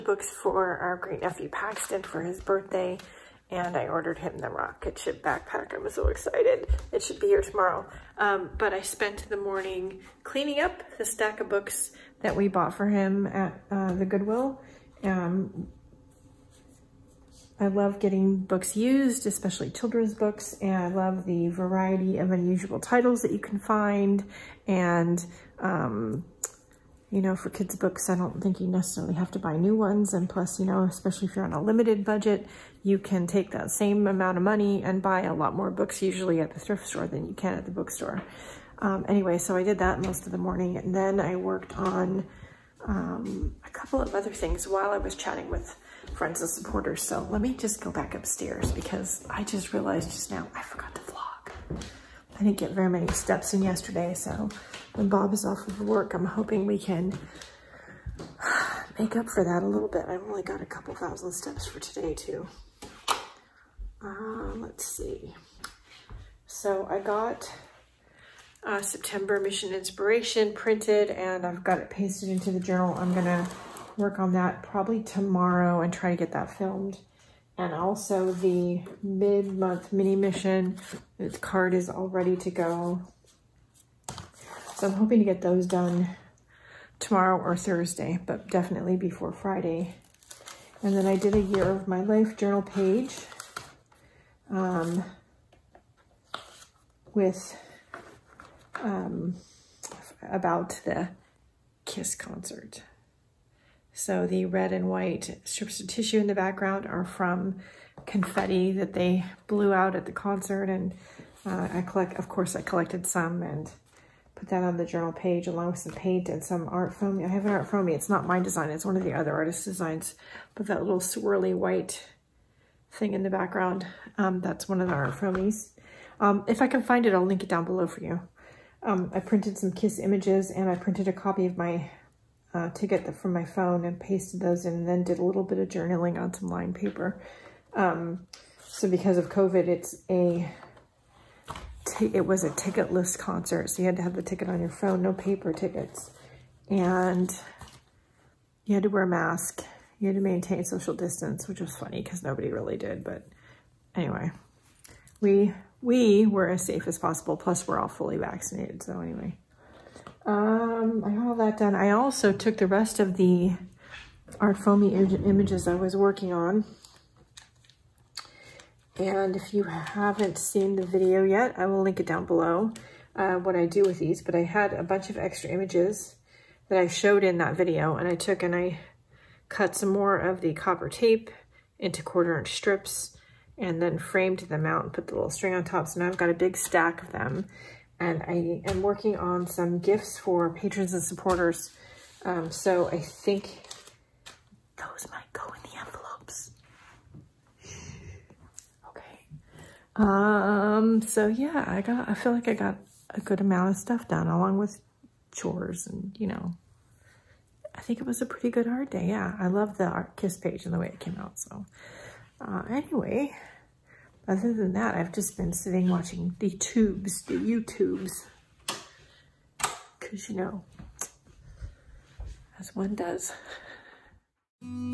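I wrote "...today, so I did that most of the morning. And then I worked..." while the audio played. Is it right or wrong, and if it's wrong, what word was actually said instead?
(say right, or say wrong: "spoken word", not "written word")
wrong: "anyway", not "today".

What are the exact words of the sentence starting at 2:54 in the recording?
But I had a bunch of extra images that I showed in that video.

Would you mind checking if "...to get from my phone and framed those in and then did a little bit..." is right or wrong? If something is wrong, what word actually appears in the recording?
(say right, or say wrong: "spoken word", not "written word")
wrong: "pasted", not "framed".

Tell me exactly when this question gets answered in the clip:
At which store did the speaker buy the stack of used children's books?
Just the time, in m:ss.
0:14.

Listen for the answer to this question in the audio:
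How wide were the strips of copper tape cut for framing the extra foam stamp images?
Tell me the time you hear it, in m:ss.
3:02.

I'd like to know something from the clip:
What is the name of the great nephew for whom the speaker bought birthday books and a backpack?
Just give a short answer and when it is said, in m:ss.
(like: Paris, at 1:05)
Paxton, at 0:01.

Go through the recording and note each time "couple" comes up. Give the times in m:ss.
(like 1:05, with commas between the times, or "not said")
0:43, 1:00.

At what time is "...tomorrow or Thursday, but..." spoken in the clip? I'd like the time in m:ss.
1:27.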